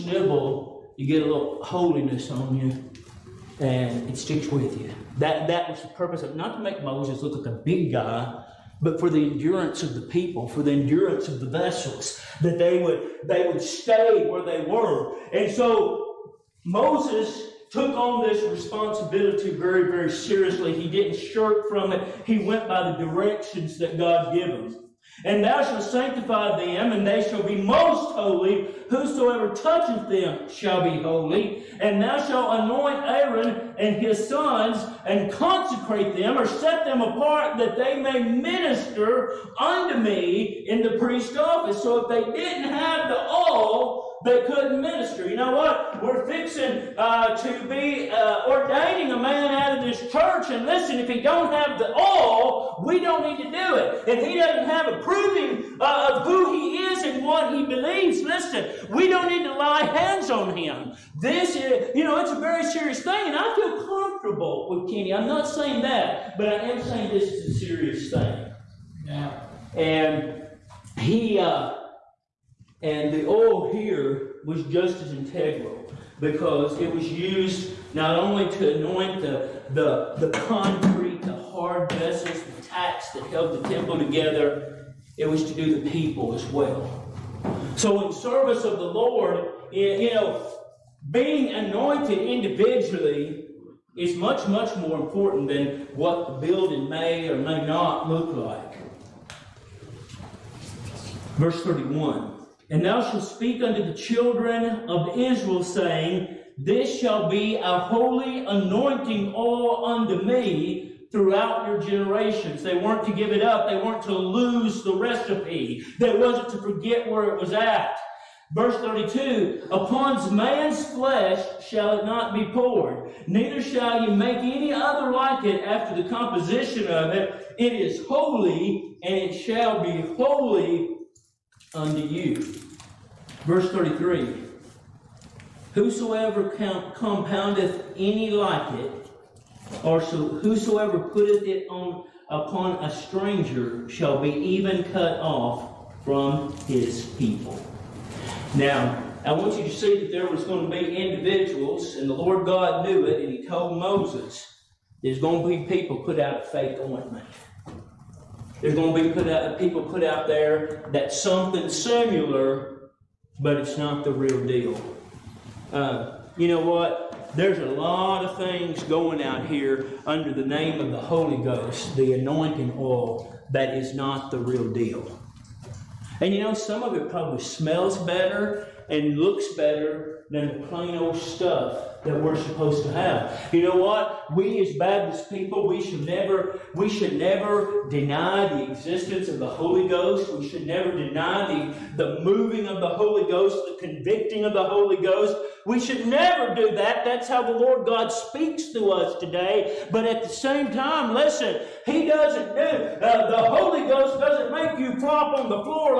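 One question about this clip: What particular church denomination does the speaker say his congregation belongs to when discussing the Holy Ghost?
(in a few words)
Baptist.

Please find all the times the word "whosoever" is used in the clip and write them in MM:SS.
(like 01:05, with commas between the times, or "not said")
00:28, 02:15, 02:20.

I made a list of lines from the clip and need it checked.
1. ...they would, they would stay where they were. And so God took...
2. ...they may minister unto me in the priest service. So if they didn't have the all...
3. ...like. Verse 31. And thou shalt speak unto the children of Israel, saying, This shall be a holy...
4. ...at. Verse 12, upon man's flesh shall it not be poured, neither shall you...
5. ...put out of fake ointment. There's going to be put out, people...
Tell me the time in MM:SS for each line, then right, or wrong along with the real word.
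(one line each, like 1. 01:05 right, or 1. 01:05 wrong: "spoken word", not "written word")
1. 00:12 wrong: "Moses", not "God"
2. 00:37 wrong: "office", not "service"
3. 01:38 right
4. 01:57 wrong: "32", not "12"
5. 02:35 right.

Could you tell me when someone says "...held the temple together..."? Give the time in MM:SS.
01:23.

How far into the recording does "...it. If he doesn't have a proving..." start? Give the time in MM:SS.
00:53.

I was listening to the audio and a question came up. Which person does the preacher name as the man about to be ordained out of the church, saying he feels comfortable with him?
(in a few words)
Kenny.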